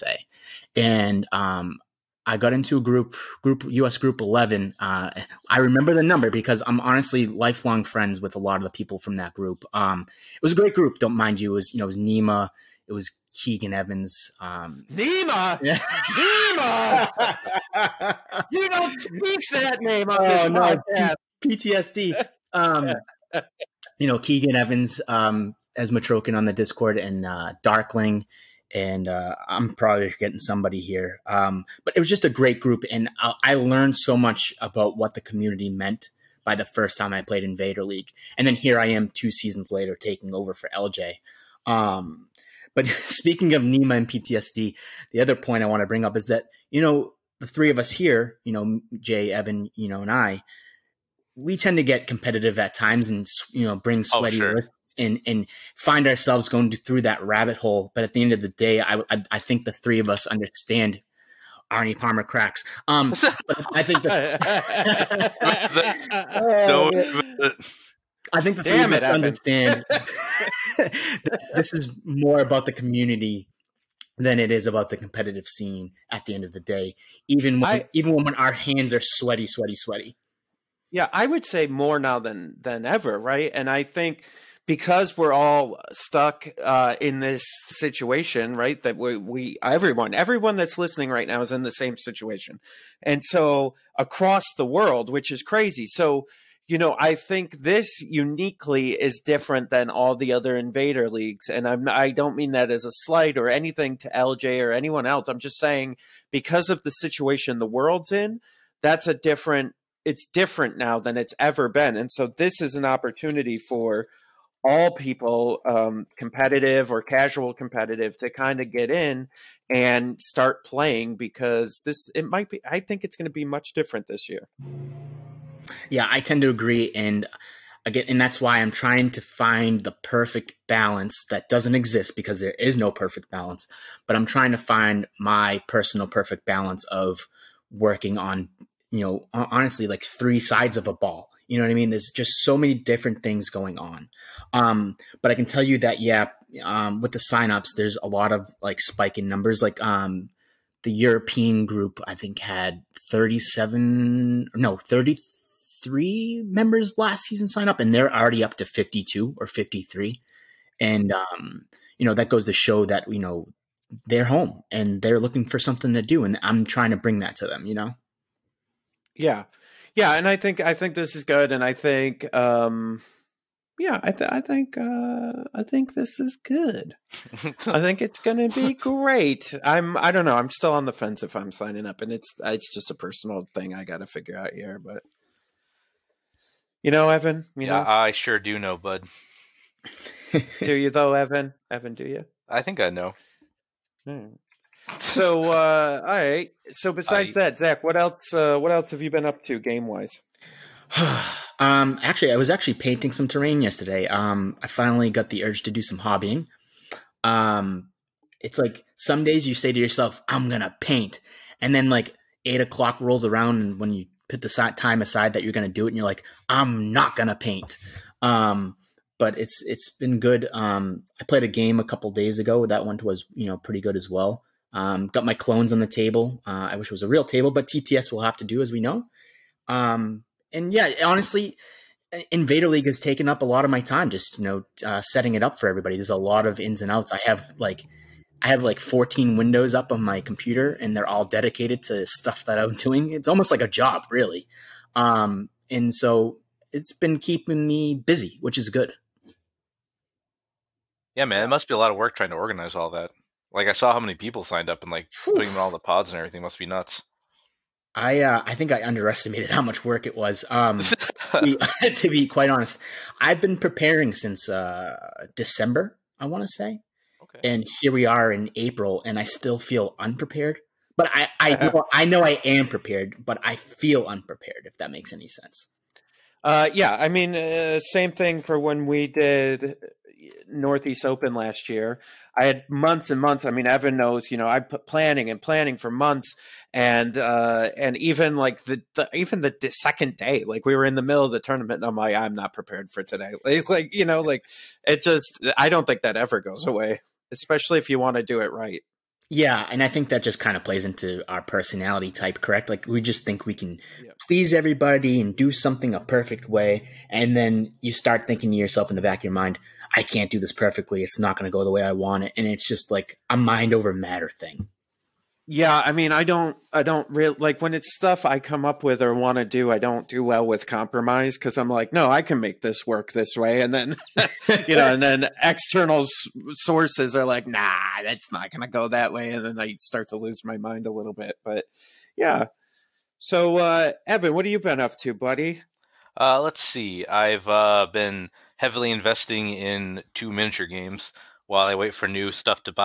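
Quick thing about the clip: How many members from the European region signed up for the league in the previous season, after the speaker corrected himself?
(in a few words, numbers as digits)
33.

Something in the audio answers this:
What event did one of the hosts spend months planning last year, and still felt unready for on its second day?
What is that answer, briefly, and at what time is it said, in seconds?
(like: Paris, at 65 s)
Northeast Open, at 280 s.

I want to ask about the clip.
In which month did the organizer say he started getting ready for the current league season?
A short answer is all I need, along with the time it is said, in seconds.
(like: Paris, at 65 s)
December, at 265 s.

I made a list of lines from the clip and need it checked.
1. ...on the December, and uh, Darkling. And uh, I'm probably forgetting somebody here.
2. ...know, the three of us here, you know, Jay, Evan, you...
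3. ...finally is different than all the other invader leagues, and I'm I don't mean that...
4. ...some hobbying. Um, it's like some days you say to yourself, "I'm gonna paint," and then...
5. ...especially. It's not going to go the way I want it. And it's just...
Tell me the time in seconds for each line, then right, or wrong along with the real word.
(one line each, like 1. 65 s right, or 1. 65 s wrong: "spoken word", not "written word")
1. 26 s wrong: "Discord", not "December"
2. 46 s right
3. 98 s wrong: "uniquely", not "finally"
4. 205 s right
5. 310 s wrong: "perfectly", not "especially".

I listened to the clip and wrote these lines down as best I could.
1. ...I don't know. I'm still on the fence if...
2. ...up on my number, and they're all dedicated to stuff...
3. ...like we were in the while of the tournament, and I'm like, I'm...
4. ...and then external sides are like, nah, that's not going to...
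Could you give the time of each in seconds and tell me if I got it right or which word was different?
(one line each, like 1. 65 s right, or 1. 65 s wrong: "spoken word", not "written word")
1. 179 s right
2. 239 s wrong: "computer", not "number"
3. 290 s wrong: "middle", not "while"
4. 324 s wrong: "sources", not "sides".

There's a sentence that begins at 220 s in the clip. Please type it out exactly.
Um, I played a game a couple days ago.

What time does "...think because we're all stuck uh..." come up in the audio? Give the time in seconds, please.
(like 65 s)
83 s.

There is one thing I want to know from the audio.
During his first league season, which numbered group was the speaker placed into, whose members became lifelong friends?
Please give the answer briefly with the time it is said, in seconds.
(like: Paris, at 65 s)
11, at 3 s.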